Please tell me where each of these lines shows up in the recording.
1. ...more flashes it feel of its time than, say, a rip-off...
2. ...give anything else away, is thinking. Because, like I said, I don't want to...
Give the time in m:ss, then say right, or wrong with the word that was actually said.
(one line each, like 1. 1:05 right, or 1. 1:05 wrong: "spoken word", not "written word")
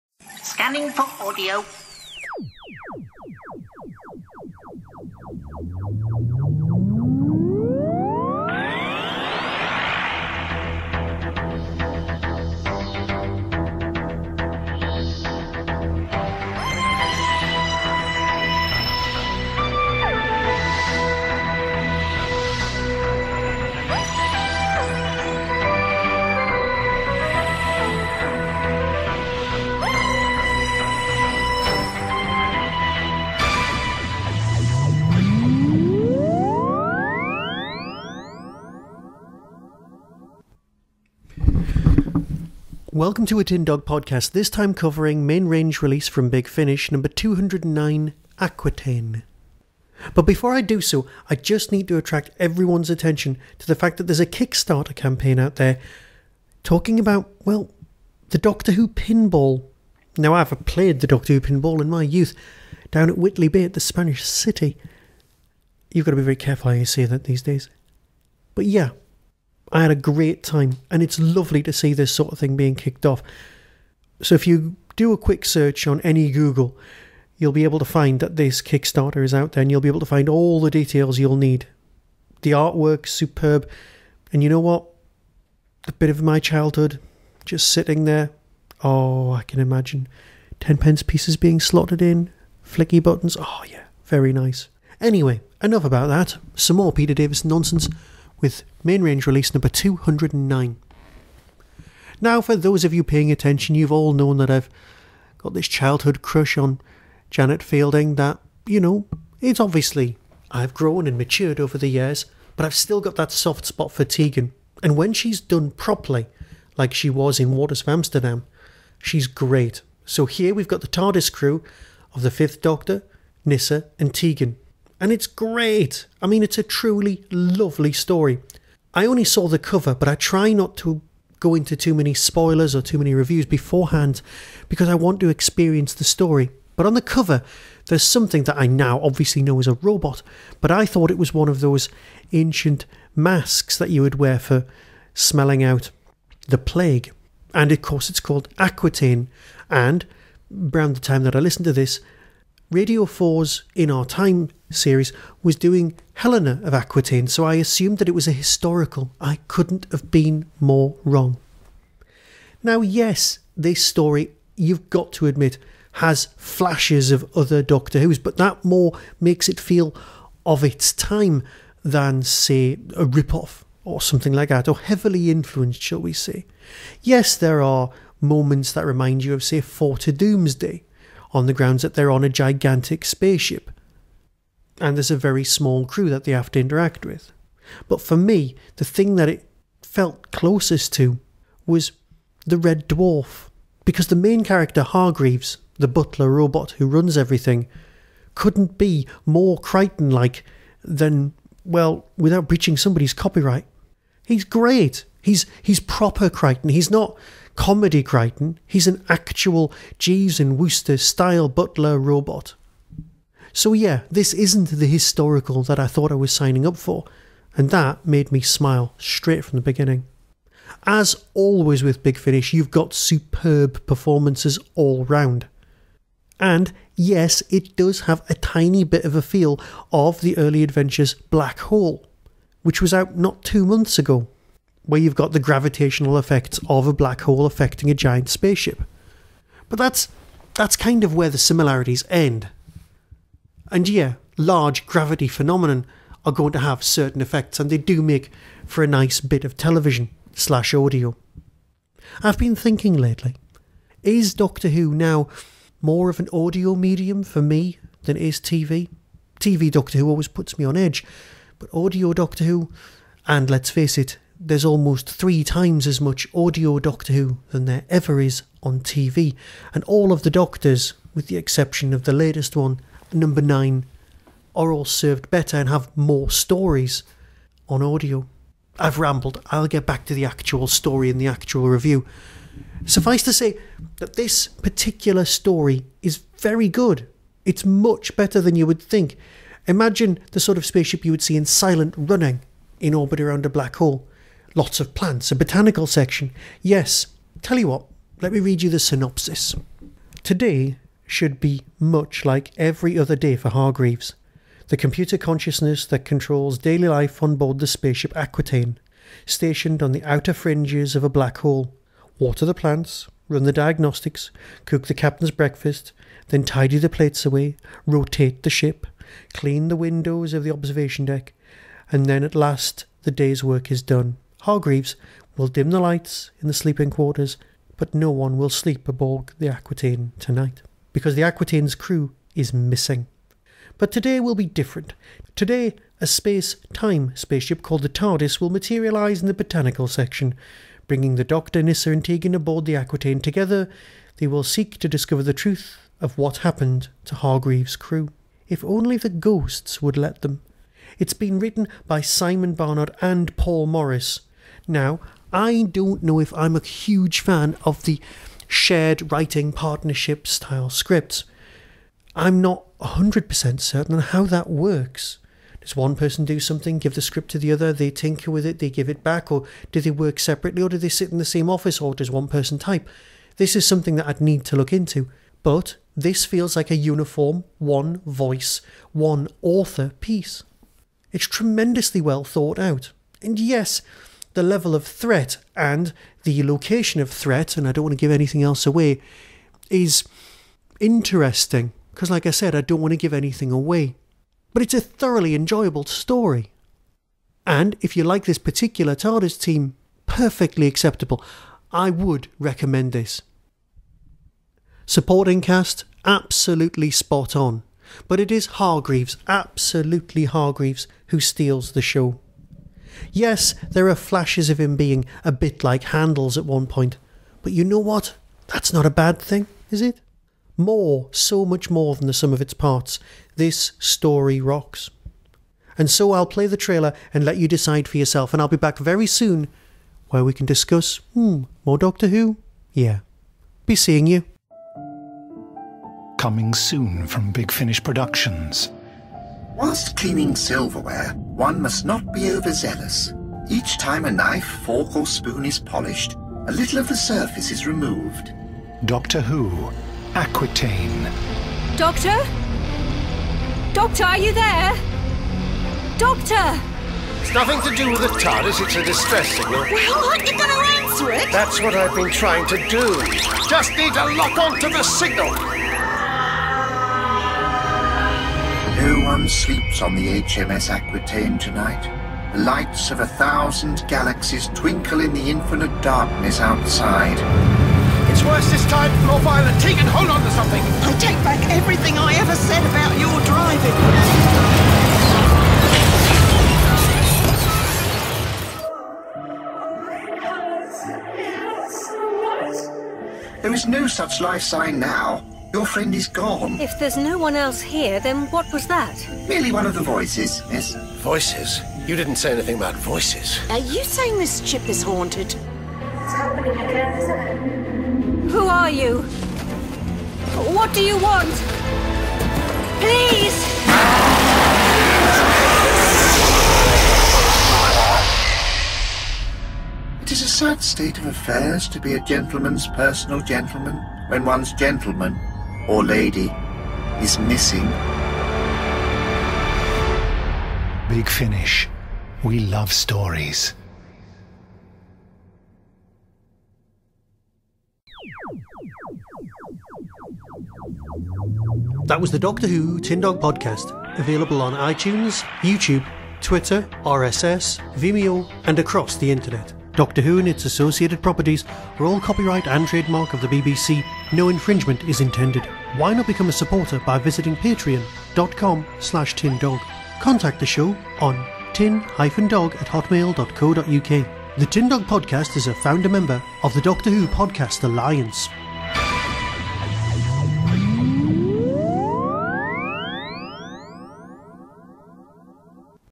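1. 2:48 wrong: "makes", not "flashes"
2. 6:28 wrong: "interesting", not "thinking".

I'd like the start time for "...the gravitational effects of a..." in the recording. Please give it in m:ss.
3:55.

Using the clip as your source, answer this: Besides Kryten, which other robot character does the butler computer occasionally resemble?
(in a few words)
Handles.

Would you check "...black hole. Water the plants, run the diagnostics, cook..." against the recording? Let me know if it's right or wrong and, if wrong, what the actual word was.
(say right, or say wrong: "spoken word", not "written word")
right.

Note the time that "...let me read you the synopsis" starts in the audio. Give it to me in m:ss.
4:58.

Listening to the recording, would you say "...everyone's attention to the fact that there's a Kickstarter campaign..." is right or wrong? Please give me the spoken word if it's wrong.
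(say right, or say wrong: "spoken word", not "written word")
right.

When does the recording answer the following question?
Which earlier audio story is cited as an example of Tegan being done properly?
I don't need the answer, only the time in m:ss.
1:57.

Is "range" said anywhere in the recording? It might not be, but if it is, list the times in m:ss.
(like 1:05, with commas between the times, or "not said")
0:45, 1:39.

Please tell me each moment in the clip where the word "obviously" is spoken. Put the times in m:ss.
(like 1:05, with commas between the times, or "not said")
1:49, 2:19.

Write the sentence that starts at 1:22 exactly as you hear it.
The artwork superb, and you know what?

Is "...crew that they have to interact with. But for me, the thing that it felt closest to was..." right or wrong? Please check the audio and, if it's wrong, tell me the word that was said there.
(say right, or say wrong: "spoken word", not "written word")
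right.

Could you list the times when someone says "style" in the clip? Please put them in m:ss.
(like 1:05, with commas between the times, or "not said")
3:30, 6:00.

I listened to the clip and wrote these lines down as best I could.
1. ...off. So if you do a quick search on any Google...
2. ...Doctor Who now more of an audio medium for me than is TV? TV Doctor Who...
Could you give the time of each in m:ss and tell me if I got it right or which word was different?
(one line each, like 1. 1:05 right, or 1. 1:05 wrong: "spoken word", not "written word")
1. 1:13 right
2. 4:14 right.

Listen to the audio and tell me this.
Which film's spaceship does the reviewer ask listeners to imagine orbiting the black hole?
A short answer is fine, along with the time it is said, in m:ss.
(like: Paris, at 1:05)
Silent Running, at 4:51.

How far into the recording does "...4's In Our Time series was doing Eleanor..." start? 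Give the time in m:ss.
2:33.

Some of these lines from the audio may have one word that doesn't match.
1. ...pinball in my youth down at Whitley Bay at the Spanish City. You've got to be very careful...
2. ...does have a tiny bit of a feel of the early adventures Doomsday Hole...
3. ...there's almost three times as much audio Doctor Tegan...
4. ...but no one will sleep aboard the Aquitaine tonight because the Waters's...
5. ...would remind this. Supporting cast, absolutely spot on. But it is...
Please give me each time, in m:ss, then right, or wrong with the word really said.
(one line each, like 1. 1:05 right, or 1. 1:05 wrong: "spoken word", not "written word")
1. 1:01 right
2. 3:47 wrong: "Black", not "Doomsday"
3. 4:24 wrong: "Who", not "Tegan"
4. 5:27 wrong: "Aquitaine", not "Waters"
5. 6:41 wrong: "recommend", not "remind".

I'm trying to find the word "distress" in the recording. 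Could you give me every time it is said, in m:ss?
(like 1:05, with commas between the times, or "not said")
7:38.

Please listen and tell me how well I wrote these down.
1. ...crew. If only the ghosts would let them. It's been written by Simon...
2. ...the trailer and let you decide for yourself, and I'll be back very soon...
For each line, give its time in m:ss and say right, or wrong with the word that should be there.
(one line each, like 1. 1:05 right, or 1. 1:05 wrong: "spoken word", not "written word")
1. 5:47 right
2. 7:06 right.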